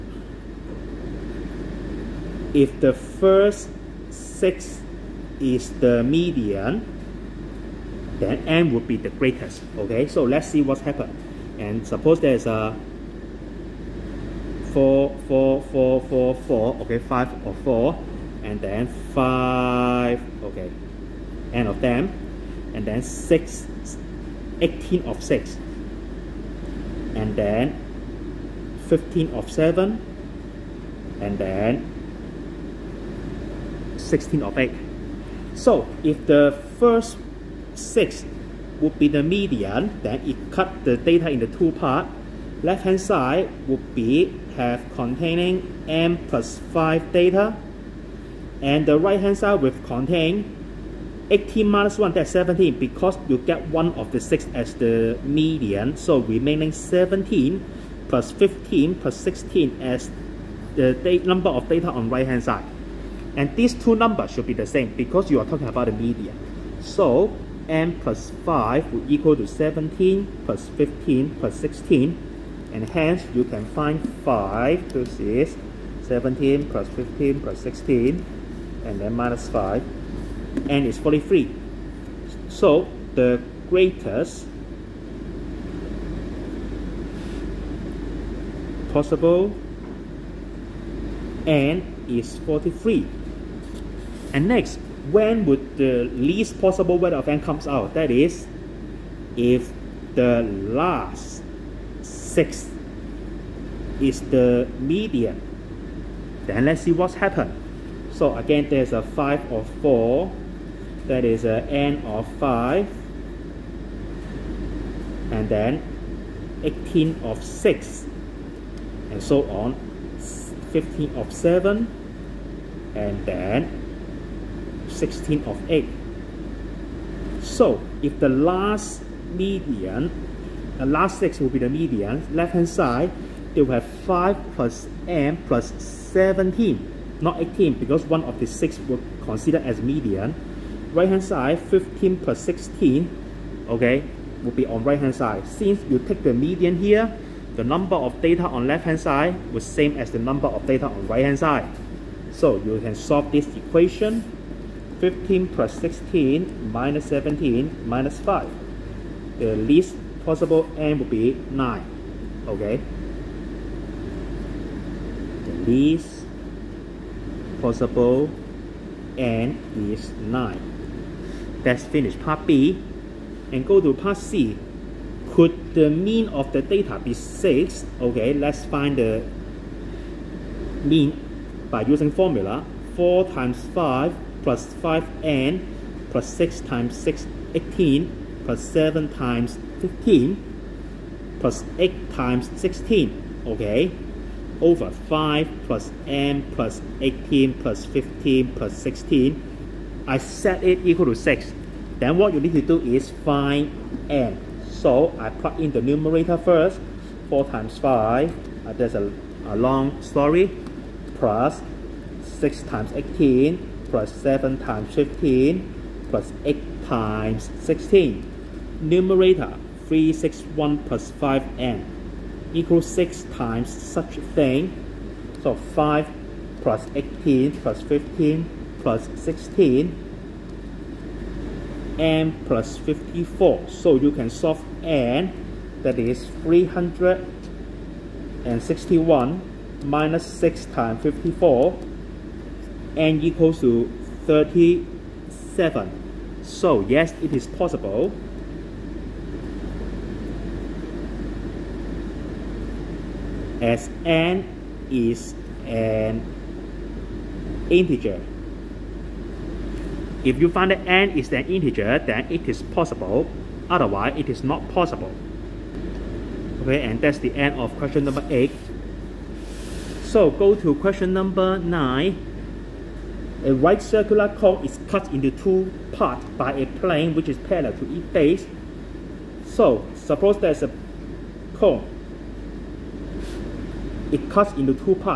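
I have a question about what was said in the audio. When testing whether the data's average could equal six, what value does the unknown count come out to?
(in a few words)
37.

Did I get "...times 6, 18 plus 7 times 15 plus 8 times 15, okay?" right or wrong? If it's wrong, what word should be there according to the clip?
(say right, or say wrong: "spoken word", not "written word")
wrong: "16", not "15".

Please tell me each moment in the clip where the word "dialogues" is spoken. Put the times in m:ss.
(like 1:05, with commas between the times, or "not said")
not said.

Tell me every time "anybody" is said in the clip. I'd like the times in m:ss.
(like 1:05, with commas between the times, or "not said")
not said.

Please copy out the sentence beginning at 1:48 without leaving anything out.
So again, there's a 5 of 4.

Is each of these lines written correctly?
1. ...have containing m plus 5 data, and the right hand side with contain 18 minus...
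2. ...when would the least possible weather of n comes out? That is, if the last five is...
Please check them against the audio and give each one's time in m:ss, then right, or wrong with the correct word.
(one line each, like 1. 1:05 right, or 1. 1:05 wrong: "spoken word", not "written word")
1. 0:44 right
2. 1:35 wrong: "six", not "five".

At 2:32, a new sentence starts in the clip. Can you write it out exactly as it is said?
So you can solve this equation 15 plus 16 minus 17 minus 5.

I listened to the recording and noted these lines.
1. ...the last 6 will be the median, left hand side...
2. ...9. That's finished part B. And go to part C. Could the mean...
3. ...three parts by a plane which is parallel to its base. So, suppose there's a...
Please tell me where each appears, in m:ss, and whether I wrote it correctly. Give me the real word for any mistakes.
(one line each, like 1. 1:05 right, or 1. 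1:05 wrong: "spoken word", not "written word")
1. 2:10 right
2. 2:50 right
3. 4:35 wrong: "two", not "three".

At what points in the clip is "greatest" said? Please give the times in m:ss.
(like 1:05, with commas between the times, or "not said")
0:09, 1:23.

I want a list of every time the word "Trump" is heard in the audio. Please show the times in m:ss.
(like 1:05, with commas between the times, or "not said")
not said.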